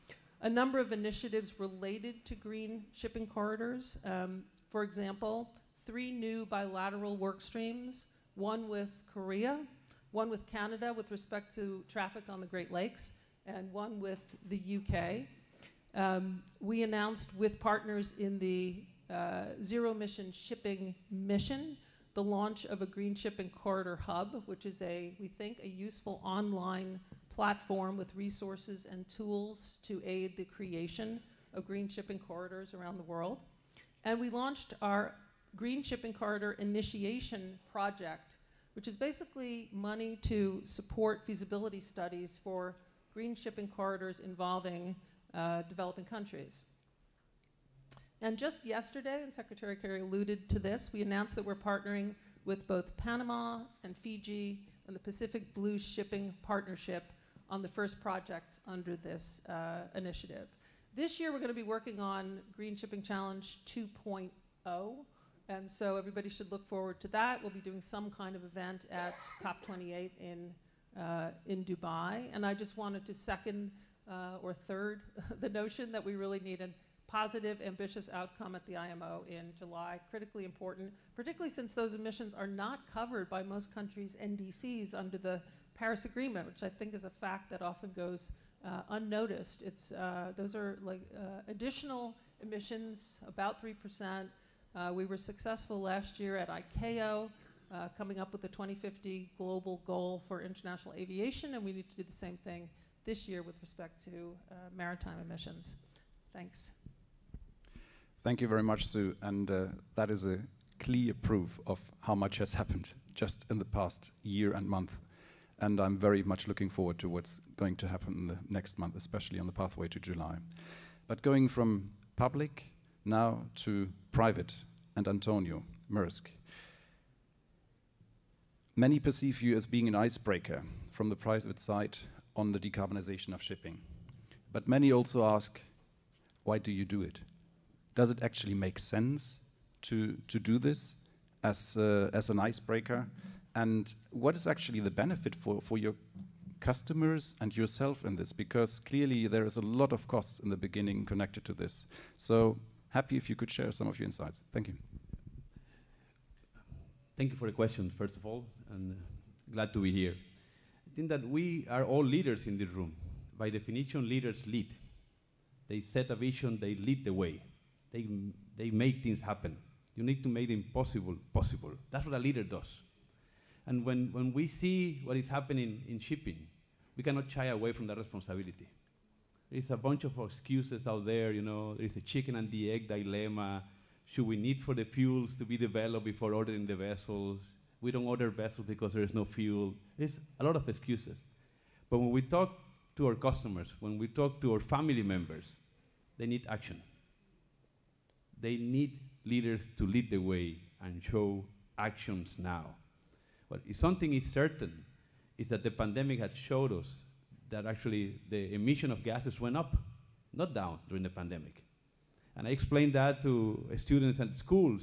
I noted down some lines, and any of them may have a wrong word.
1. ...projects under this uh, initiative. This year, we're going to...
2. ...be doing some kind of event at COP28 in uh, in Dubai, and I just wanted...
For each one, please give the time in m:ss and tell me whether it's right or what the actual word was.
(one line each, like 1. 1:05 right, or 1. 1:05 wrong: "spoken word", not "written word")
1. 0:58 right
2. 1:07 right.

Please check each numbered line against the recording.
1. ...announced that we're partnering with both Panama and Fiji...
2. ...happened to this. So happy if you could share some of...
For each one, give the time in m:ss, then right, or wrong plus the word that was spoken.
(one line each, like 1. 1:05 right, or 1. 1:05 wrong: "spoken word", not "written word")
1. 0:51 right
2. 2:31 wrong: "connected", not "happened".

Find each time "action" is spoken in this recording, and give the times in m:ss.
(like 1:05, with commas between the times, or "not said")
3:16, 3:21.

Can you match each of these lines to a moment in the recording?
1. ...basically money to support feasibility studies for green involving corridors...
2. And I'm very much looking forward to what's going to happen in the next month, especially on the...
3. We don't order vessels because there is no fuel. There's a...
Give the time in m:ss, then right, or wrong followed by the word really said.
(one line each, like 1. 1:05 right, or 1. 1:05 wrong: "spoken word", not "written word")
1. 0:38 wrong: "shipping", not "involving"
2. 1:55 right
3. 3:07 right.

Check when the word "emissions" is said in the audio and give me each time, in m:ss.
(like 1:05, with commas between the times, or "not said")
0:19, 1:21, 1:32, 1:45, 3:28.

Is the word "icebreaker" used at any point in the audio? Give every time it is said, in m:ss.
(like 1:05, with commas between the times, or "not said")
2:09, 2:22.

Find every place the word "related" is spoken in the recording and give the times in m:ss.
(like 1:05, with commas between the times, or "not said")
0:01.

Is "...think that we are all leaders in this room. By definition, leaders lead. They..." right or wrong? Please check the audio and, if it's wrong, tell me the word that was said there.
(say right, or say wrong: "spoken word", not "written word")
right.